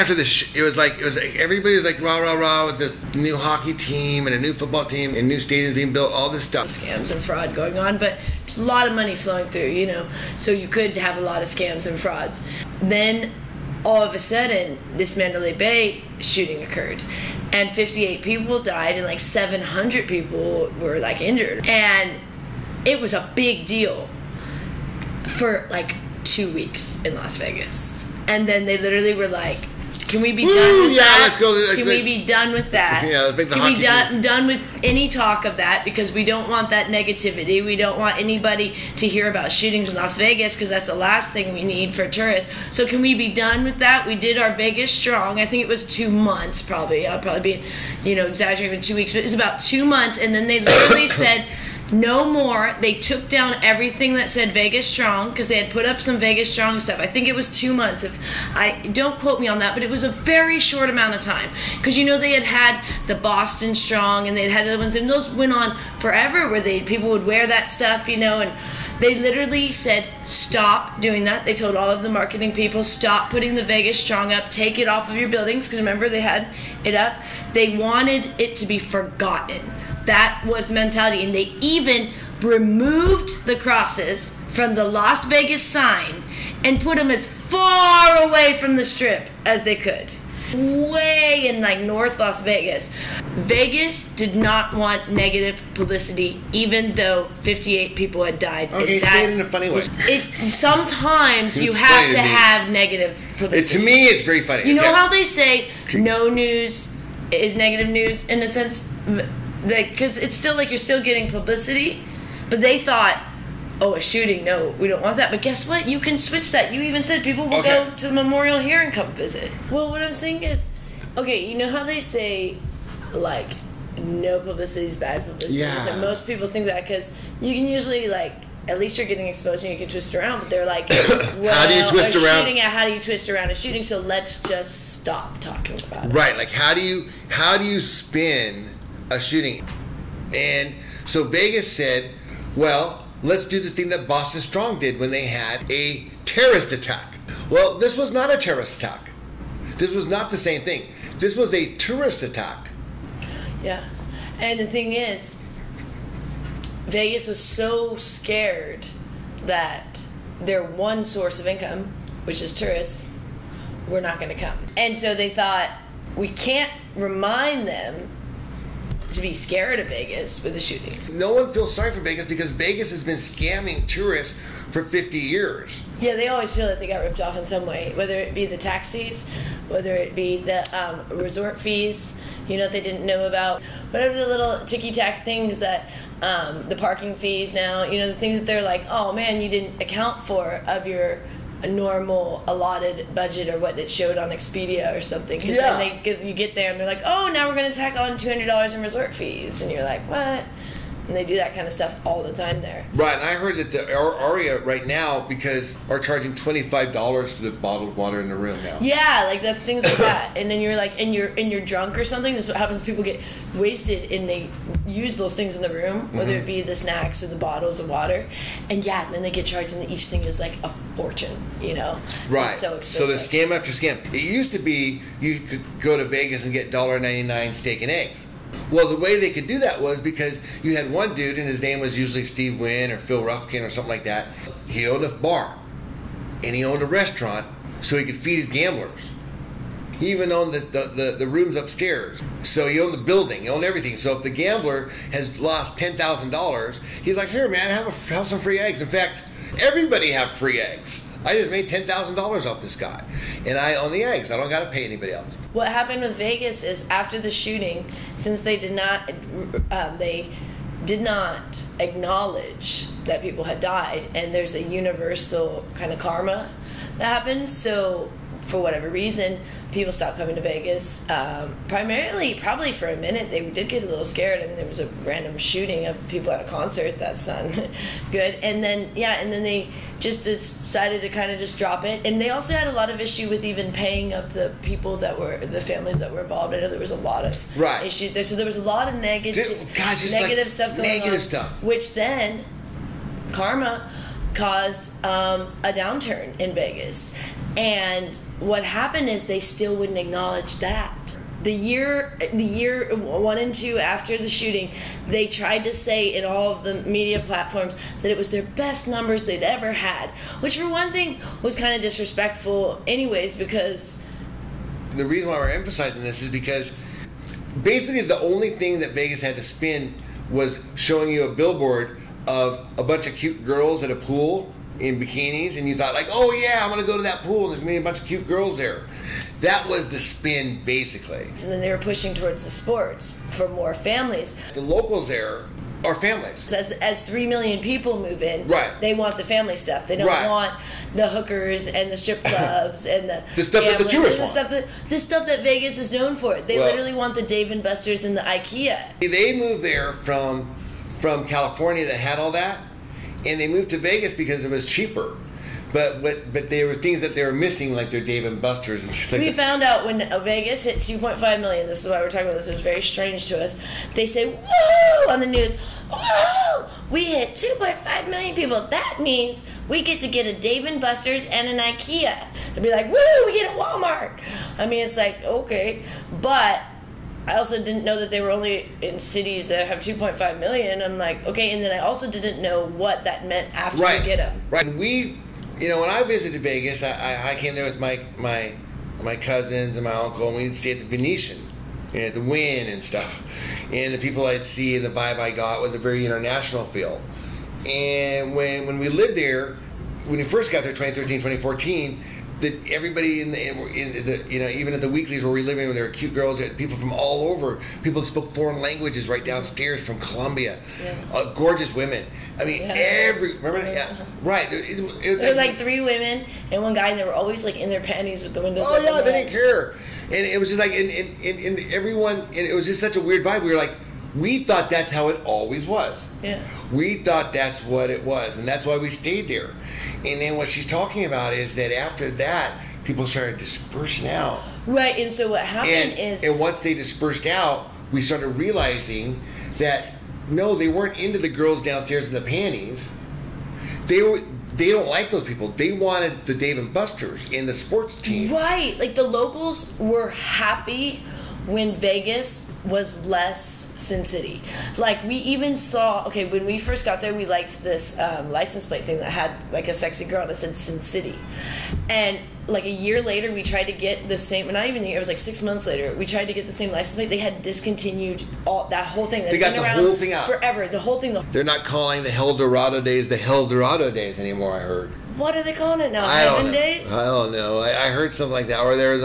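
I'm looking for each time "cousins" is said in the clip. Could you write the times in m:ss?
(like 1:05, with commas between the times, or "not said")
6:29.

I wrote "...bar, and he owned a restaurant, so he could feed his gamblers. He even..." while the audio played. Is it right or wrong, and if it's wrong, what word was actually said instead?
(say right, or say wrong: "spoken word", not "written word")
right.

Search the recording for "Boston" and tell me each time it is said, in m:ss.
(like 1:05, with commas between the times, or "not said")
1:03, 2:24.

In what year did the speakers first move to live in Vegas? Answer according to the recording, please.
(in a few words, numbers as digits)
2013.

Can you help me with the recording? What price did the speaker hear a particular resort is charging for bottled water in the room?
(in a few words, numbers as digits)
$25.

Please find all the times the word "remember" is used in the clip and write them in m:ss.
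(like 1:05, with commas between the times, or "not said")
1:15, 6:53.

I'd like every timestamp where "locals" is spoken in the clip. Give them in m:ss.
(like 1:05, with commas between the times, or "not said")
5:34, 7:29.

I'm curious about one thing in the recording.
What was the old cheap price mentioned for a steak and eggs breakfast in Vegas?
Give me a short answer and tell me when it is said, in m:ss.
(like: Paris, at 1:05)
$1.99, at 3:46.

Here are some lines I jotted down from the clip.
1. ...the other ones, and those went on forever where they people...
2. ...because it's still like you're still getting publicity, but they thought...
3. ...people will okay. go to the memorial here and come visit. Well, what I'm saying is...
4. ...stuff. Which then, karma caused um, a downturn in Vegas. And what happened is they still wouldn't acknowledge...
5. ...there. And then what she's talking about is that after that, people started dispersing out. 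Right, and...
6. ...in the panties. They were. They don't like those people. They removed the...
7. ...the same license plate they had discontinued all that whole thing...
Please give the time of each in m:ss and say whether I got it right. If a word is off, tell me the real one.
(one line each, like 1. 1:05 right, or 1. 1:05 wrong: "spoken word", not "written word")
1. 1:04 right
2. 1:49 right
3. 1:57 right
4. 4:51 right
5. 7:09 right
6. 7:22 wrong: "wanted", not "removed"
7. 7:46 right.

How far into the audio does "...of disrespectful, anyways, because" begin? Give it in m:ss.
5:11.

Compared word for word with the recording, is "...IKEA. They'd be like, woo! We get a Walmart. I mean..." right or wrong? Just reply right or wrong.
right.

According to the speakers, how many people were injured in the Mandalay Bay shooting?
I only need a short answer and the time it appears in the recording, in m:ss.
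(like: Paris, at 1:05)
700, at 0:19.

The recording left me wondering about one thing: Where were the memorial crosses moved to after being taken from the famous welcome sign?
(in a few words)
North Las Vegas.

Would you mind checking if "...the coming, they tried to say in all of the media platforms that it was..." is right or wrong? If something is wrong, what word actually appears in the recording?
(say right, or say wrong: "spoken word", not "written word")
wrong: "shooting", not "coming".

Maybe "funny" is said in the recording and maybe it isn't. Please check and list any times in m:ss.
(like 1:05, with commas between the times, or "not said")
1:39, 1:44.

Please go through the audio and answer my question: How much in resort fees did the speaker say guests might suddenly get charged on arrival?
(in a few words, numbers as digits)
$200.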